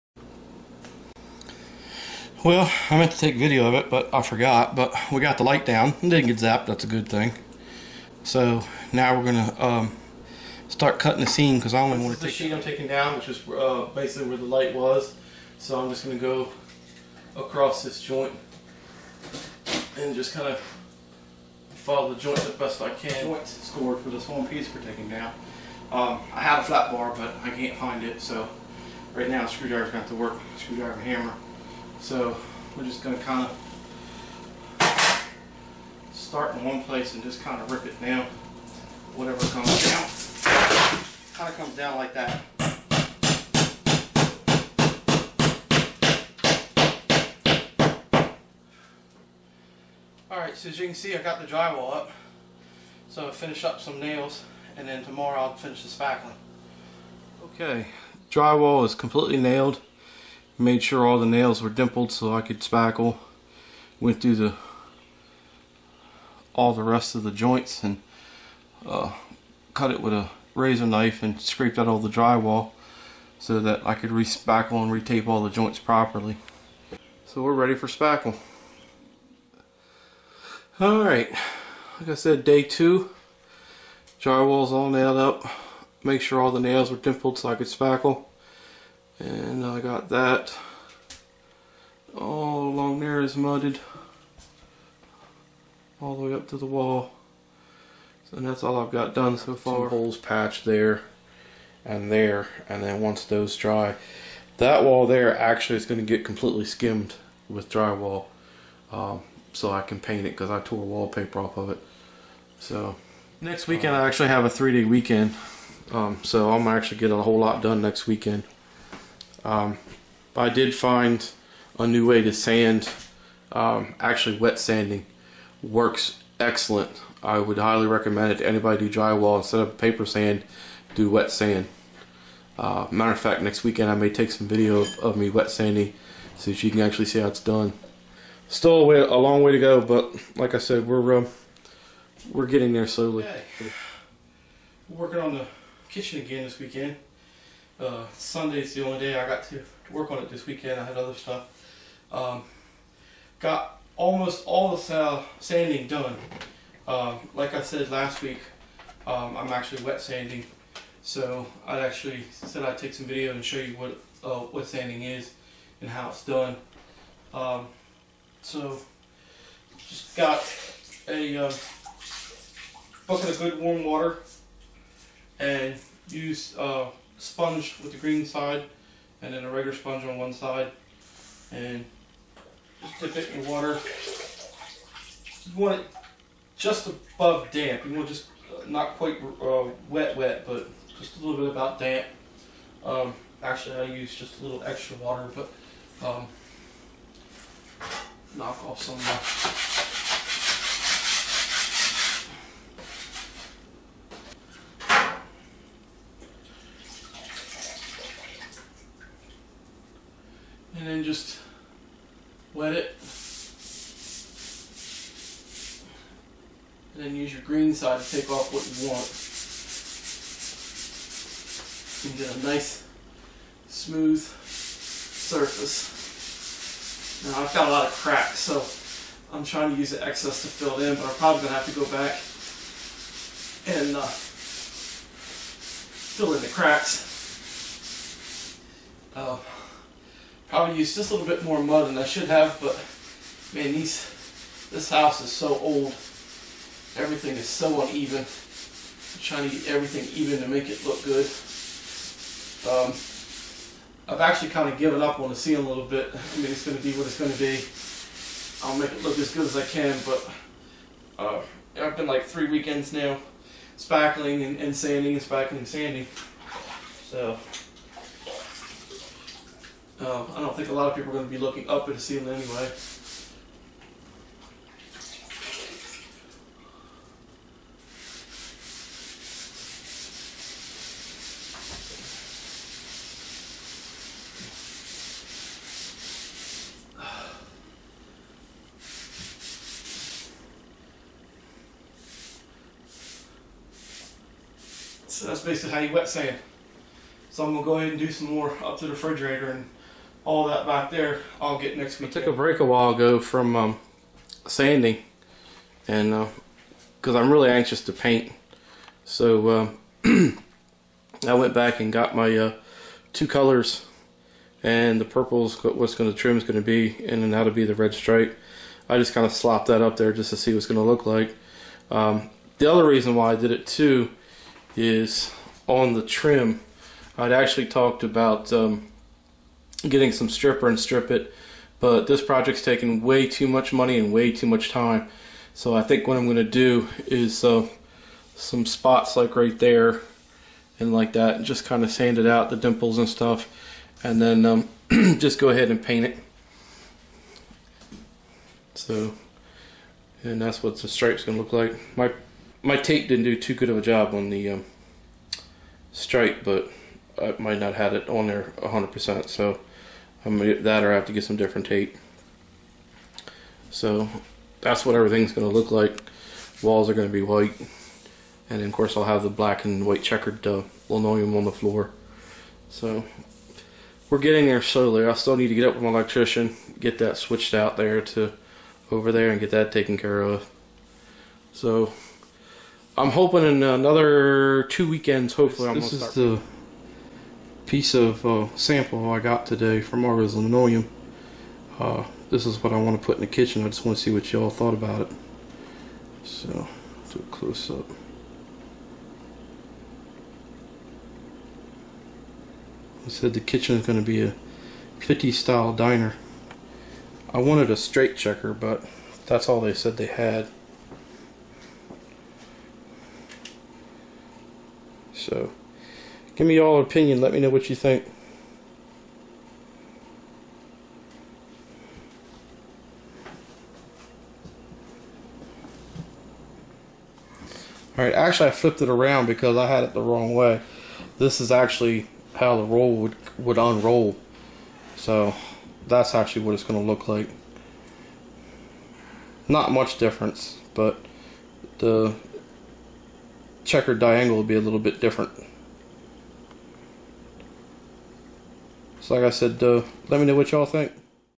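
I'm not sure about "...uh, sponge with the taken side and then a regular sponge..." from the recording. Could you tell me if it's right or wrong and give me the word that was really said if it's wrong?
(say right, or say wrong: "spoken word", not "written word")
wrong: "green", not "taken".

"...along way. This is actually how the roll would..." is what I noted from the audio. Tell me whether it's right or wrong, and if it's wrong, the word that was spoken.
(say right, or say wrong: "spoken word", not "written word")
wrong: "wrong", not "along".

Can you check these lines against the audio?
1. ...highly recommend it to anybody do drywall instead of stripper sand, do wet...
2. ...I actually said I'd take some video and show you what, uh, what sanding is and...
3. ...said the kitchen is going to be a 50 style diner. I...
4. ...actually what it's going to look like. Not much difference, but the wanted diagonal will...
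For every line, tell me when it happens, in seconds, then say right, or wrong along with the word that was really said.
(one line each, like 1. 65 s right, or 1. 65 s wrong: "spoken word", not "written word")
1. 127 s wrong: "paper", not "stripper"
2. 161 s right
3. 403 s right
4. 436 s wrong: "checkered", not "wanted".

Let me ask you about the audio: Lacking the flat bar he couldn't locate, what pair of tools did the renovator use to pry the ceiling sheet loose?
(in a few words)
Screwdriver and hammer.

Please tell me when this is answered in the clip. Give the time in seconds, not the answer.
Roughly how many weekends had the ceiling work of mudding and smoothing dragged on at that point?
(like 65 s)
262 s.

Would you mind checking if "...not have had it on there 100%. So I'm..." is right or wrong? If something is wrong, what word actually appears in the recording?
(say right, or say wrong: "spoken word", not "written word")
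right.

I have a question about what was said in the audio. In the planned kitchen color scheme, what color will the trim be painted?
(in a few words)
purple.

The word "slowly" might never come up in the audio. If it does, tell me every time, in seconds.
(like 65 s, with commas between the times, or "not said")
142 s, 374 s.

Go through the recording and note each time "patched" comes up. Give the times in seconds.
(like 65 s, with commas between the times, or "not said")
100 s.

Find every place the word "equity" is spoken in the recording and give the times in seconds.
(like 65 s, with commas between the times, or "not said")
not said.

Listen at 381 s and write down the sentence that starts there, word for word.
So I'm hoping in another two weekends, hopefully.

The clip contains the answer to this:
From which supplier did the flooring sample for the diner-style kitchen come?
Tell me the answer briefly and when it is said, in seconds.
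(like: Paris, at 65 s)
Argos Linoleum, at 390 s.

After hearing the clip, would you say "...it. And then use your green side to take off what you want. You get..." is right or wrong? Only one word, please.
right.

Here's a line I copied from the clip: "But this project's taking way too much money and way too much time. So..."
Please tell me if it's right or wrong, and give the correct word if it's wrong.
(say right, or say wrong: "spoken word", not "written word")
right.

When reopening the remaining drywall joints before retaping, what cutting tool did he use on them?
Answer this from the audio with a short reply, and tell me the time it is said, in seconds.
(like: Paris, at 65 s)
razor knife, at 70 s.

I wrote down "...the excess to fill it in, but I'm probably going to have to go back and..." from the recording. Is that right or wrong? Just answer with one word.
right.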